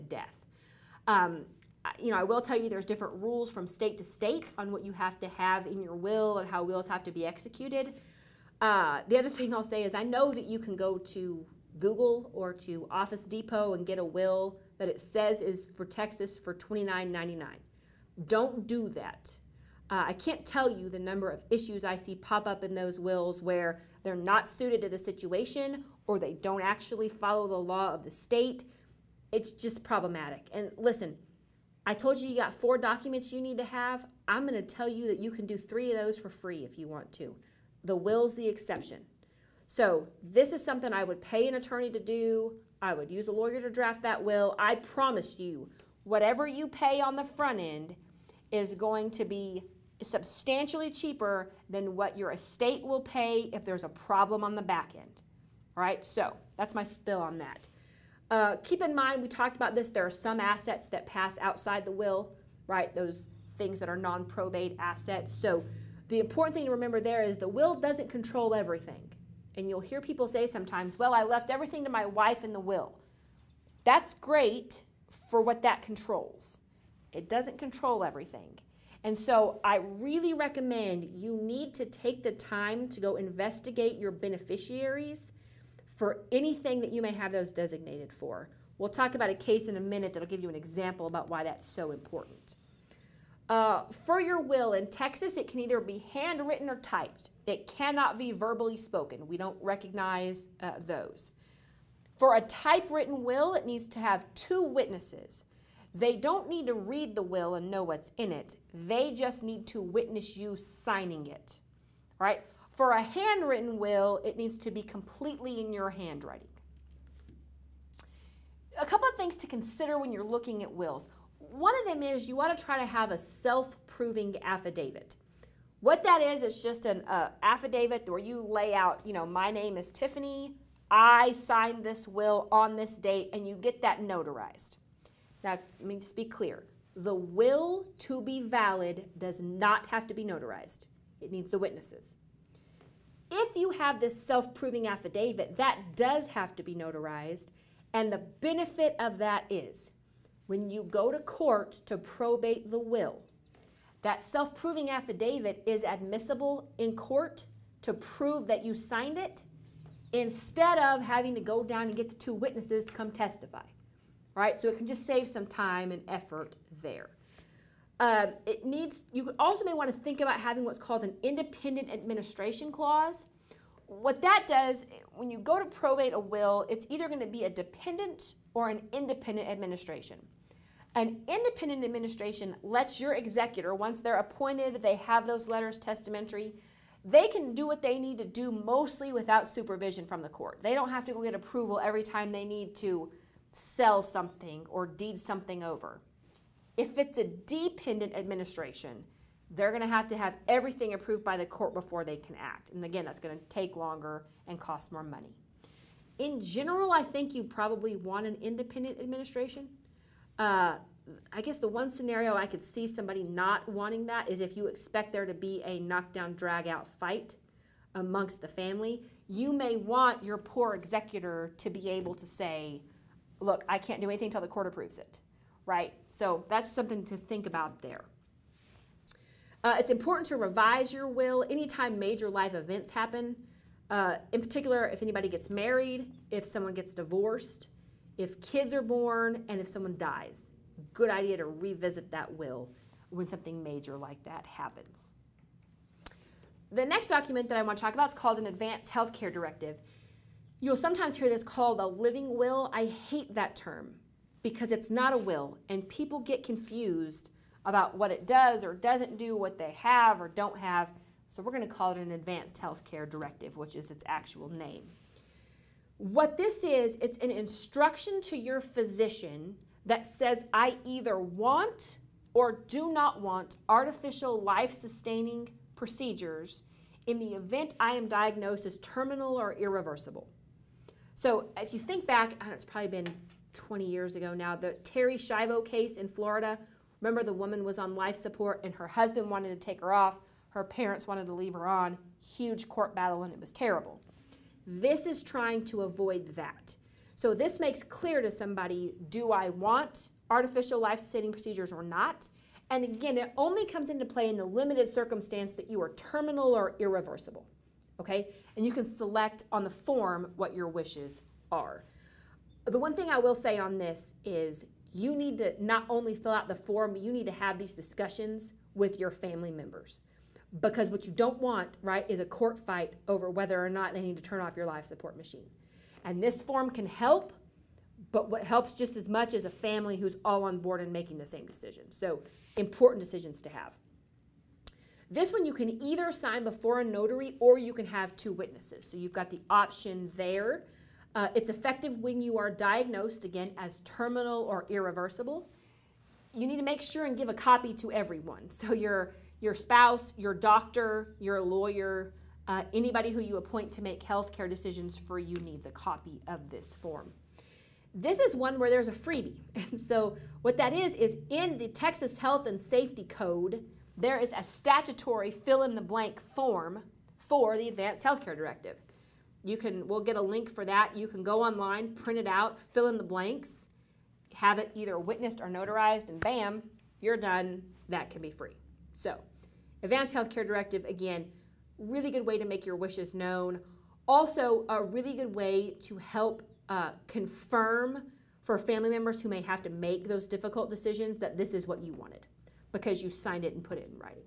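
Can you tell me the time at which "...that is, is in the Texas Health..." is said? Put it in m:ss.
6:00.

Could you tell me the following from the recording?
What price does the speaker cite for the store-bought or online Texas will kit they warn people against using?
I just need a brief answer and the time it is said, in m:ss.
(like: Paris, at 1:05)
$29.99, at 0:16.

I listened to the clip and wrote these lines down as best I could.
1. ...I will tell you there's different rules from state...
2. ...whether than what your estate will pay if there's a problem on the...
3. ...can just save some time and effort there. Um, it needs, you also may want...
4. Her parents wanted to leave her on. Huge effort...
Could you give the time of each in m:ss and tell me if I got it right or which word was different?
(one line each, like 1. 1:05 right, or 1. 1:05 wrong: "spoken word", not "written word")
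1. 0:02 right
2. 0:50 wrong: "cheaper", not "whether"
3. 2:44 right
4. 4:50 wrong: "court", not "effort".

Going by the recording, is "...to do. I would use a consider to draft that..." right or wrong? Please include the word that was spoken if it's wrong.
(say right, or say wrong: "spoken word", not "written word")
wrong: "lawyer", not "consider".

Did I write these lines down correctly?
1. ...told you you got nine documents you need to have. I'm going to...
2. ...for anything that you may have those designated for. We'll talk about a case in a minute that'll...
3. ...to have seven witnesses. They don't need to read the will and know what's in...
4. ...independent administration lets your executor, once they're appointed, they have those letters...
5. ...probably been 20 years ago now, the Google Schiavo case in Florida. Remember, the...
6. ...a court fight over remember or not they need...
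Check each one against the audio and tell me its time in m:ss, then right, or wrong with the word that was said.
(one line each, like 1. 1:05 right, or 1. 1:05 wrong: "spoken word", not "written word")
1. 0:31 wrong: "four", not "nine"
2. 1:25 right
3. 1:43 wrong: "two", not "seven"
4. 3:01 right
5. 4:42 wrong: "Terri", not "Google"
6. 5:22 wrong: "whether", not "remember".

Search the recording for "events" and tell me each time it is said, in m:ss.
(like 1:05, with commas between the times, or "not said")
3:52, 4:37.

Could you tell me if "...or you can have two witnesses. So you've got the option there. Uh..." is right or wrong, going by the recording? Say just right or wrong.
right.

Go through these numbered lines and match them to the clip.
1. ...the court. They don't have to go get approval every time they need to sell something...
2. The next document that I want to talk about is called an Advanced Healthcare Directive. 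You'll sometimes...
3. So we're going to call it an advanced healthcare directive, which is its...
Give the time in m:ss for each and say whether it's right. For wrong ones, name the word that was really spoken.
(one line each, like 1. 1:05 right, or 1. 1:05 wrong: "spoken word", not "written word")
1. 3:10 right
2. 4:06 right
3. 4:21 right.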